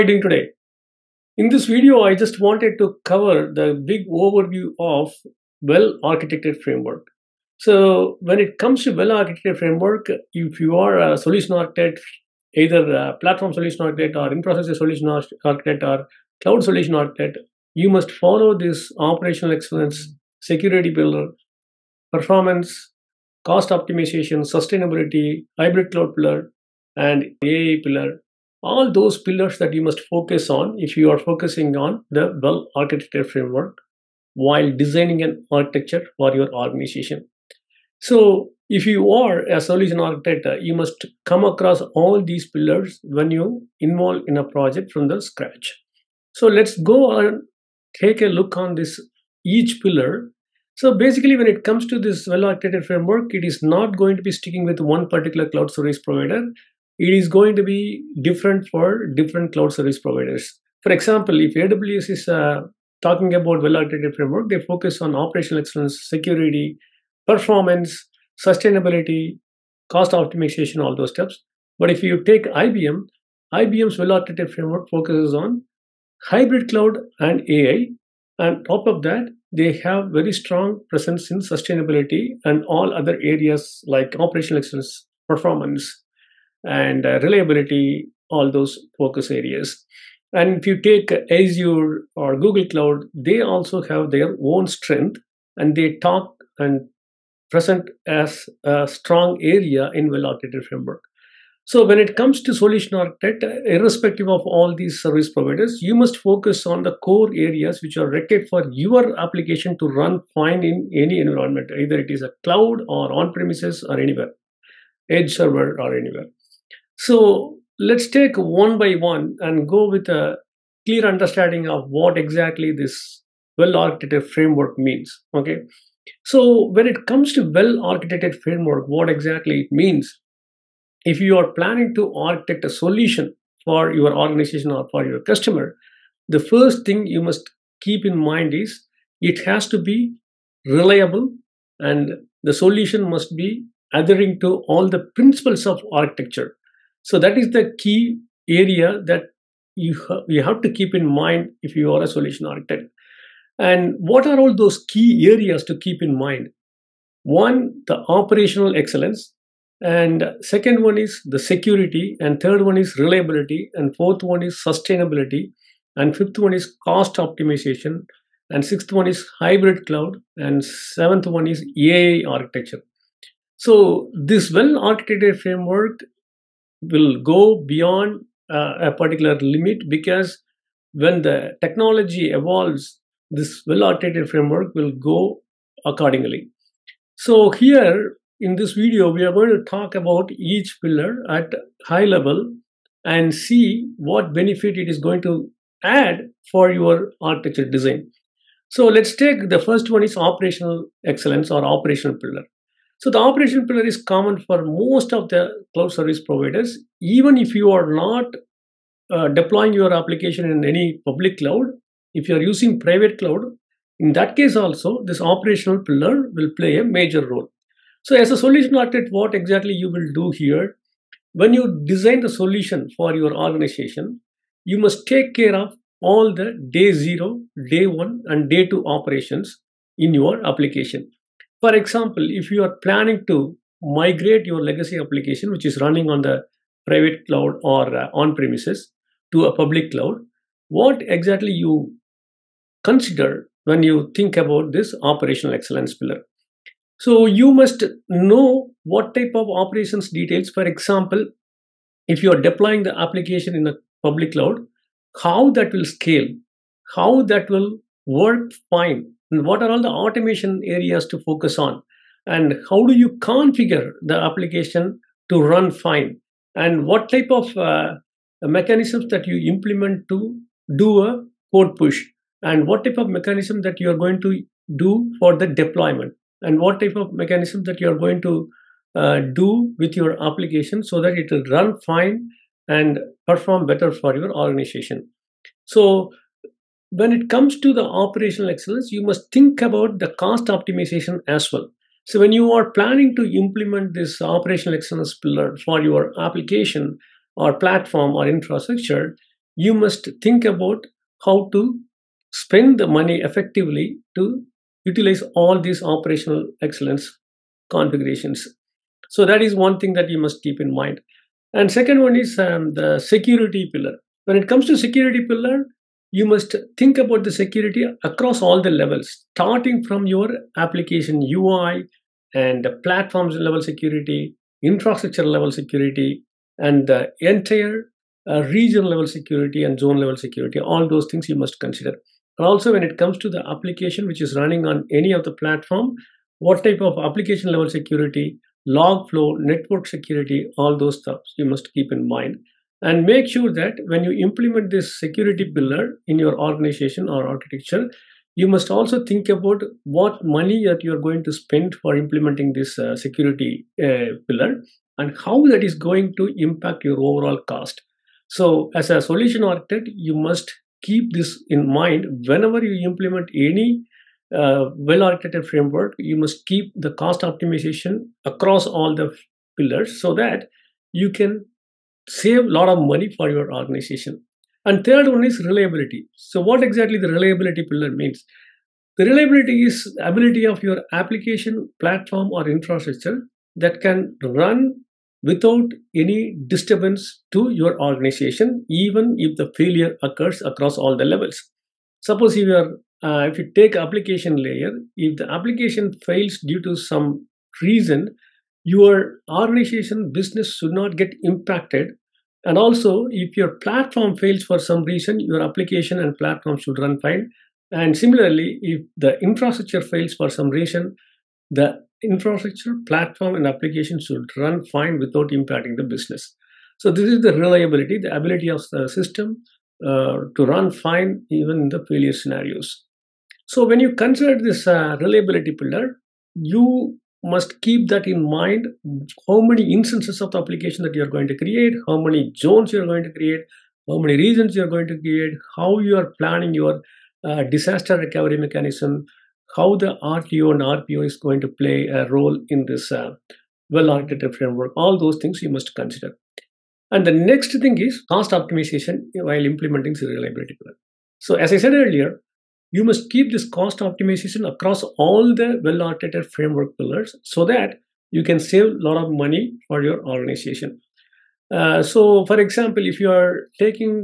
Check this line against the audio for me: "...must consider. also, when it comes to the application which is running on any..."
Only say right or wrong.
right.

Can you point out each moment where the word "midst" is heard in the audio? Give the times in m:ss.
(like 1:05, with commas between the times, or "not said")
not said.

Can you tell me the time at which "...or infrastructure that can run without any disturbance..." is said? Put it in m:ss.
6:22.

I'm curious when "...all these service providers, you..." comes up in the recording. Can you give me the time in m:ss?
1:44.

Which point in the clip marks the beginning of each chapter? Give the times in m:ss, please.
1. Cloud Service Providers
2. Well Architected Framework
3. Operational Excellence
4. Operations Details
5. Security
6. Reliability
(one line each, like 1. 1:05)
1. 0:46
2. 1:57
3. 3:07
4. 4:07
5. 5:11
6. 7:03.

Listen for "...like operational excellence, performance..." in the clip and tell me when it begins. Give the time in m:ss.
1:23.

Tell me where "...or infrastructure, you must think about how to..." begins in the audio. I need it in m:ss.
4:58.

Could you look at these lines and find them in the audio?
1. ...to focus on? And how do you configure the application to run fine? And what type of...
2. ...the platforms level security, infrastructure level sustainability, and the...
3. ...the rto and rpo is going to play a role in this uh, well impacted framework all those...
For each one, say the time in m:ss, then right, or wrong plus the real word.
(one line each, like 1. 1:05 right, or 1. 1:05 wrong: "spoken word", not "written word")
1. 4:21 right
2. 5:22 wrong: "security", not "sustainability"
3. 7:19 wrong: "architected", not "impacted".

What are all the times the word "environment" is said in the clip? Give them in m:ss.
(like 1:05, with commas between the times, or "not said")
1:51.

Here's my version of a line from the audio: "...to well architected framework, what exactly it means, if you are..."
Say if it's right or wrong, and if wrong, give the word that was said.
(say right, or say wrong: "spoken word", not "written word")
right.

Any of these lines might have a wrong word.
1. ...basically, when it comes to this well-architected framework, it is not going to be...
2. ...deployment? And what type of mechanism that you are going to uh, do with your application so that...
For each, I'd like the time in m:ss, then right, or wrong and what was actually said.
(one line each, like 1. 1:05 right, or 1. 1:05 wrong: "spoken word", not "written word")
1. 0:50 right
2. 4:35 right.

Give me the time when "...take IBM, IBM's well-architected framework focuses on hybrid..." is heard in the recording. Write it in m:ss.
1:12.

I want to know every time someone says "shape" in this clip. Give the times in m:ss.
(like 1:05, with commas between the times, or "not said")
not said.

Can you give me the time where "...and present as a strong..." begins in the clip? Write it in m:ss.
1:36.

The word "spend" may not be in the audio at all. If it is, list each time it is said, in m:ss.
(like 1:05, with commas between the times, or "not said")
5:02, 5:51.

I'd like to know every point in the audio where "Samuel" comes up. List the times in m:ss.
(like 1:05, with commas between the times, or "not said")
not said.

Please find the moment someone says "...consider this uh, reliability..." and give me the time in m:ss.
7:03.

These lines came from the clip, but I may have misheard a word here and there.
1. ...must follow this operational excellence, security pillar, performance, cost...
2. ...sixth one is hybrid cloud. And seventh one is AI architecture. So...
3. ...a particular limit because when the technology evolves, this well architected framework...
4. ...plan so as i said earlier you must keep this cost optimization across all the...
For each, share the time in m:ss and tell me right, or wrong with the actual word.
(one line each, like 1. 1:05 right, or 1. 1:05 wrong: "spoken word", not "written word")
1. 0:17 right
2. 2:48 right
3. 2:58 right
4. 7:30 right.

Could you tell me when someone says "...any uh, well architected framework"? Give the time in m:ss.
6:03.